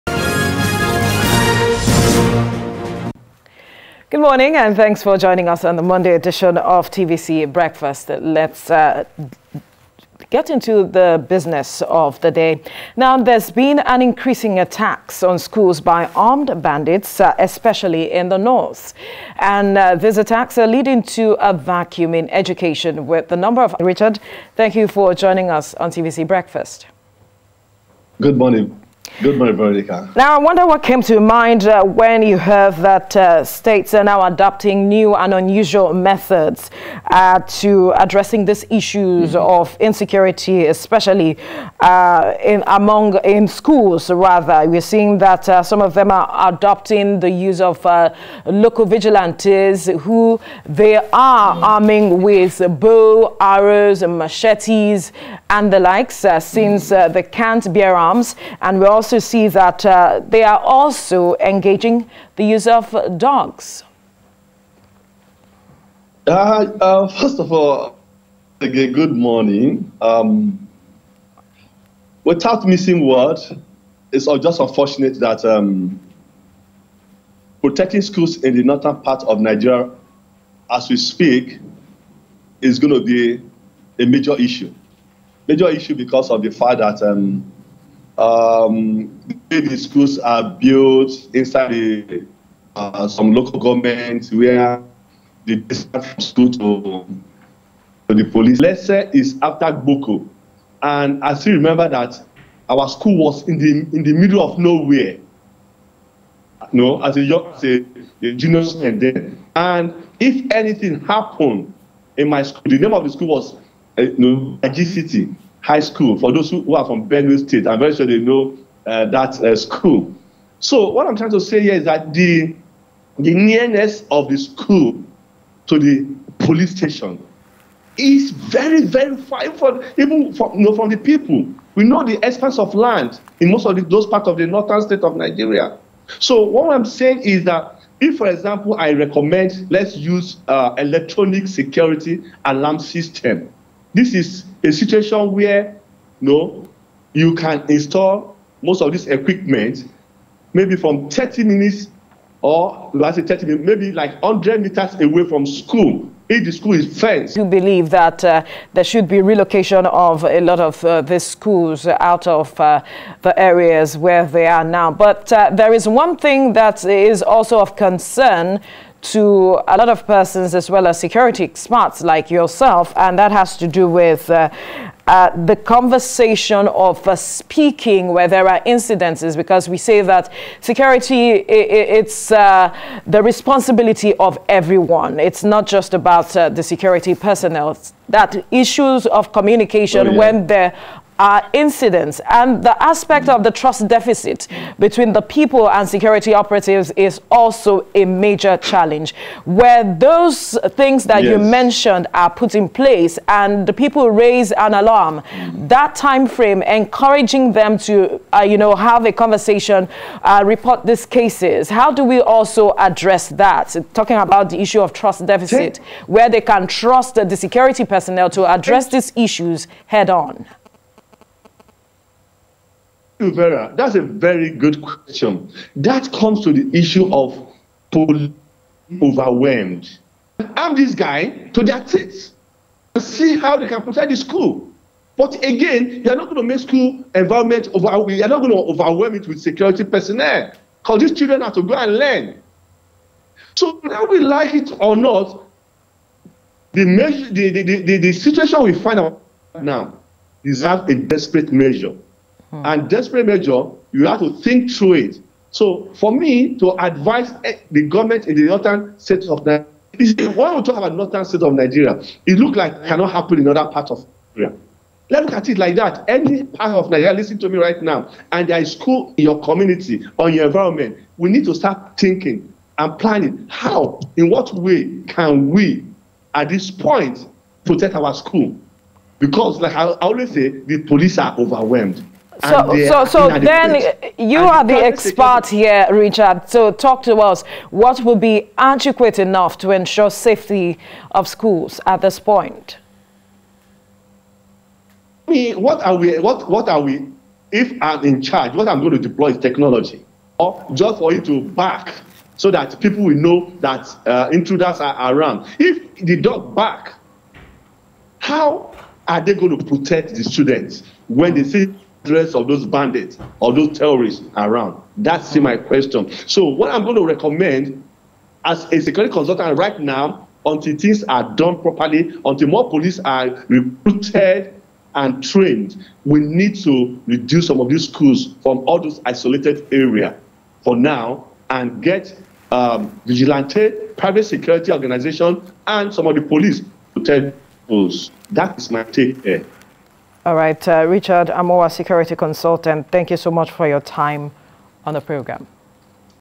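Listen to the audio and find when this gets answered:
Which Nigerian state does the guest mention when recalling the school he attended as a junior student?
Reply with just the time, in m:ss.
1:57.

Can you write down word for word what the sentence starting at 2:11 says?
We know the expanse of land in most of the, those parts of the northern state of Nigeria.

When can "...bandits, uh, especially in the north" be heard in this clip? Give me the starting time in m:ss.
0:16.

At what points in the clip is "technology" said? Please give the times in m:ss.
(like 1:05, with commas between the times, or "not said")
4:59.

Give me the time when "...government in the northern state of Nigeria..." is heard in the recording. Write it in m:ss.
4:17.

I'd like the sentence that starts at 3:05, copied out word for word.
It's not just about uh, the security personnel.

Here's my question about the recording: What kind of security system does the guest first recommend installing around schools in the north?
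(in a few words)
electronic security alarm system.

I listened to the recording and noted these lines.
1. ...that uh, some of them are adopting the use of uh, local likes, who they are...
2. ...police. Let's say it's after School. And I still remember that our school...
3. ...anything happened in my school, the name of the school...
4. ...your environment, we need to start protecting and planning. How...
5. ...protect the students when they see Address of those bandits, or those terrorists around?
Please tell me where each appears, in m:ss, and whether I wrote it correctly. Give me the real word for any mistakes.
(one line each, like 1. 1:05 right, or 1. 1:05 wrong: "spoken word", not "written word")
1. 0:45 wrong: "vigilantes", not "likes"
2. 1:38 wrong: "Boko", not "School"
3. 1:50 right
4. 4:30 wrong: "thinking", not "protecting"
5. 5:09 right.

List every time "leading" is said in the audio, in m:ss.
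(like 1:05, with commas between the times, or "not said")
0:20.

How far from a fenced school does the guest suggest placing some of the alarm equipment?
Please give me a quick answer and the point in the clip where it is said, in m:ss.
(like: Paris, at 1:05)
100 meters, at 2:34.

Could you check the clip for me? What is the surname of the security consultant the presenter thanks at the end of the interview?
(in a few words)
Amoa.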